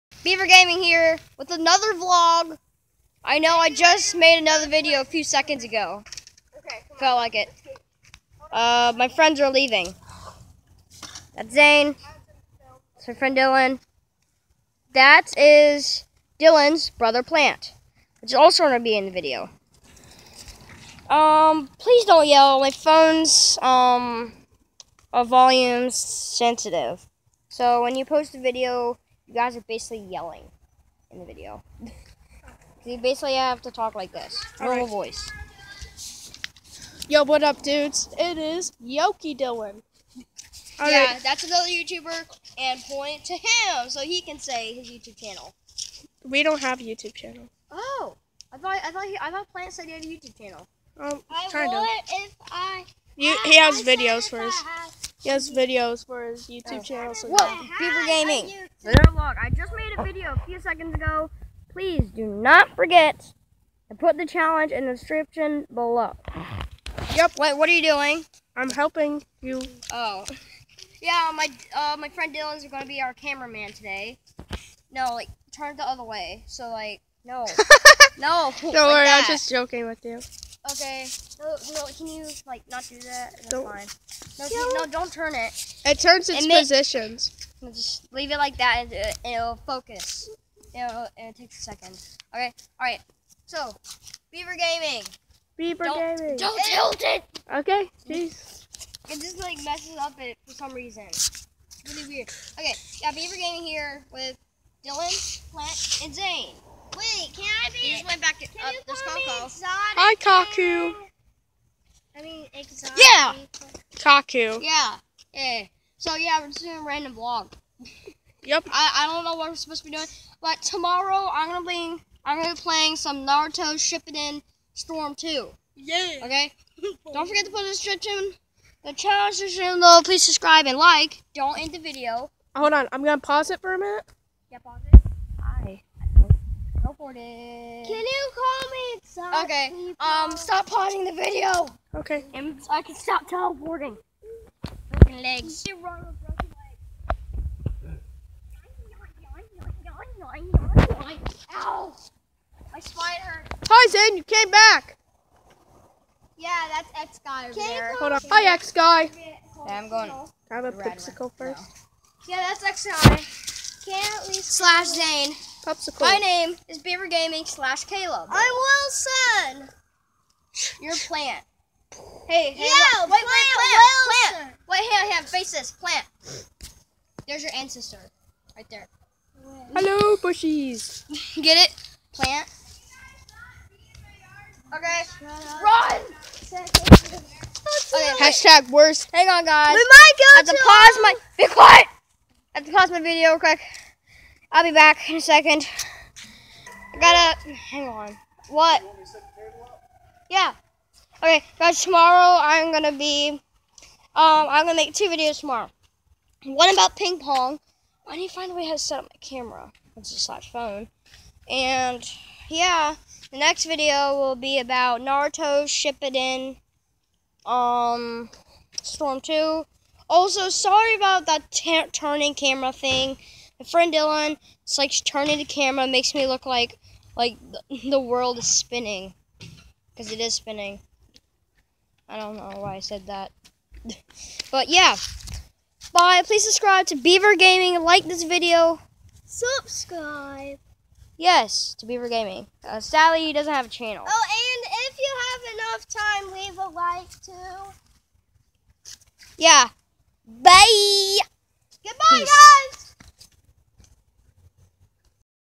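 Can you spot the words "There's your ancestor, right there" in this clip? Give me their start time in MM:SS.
02:57.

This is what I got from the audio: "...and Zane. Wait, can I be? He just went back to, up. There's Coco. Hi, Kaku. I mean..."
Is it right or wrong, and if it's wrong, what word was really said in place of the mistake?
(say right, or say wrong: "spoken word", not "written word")
right.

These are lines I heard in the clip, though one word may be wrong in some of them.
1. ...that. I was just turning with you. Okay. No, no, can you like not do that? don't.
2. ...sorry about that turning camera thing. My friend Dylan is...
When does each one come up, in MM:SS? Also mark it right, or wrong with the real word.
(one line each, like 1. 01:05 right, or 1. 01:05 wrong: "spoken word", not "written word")
1. 01:19 wrong: "joking", not "turning"
2. 03:40 right.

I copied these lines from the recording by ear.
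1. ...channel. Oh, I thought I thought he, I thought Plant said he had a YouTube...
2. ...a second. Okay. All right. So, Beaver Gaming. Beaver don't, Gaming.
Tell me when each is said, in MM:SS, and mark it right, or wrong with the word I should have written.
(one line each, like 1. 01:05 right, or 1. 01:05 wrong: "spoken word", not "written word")
1. 00:47 right
2. 01:31 right.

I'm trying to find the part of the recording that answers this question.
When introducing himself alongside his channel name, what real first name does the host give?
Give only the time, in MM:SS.
02:47.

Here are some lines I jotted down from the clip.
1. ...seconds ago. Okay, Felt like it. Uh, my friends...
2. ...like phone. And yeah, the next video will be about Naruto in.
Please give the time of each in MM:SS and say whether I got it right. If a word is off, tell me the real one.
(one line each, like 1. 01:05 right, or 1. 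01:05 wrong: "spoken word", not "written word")
1. 00:05 right
2. 03:30 right.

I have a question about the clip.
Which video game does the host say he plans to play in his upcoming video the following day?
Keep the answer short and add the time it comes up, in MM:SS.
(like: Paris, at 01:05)
Naruto Shippuden Storm 2, at 02:03.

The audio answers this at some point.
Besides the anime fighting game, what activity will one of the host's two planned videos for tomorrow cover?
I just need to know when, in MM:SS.
03:26.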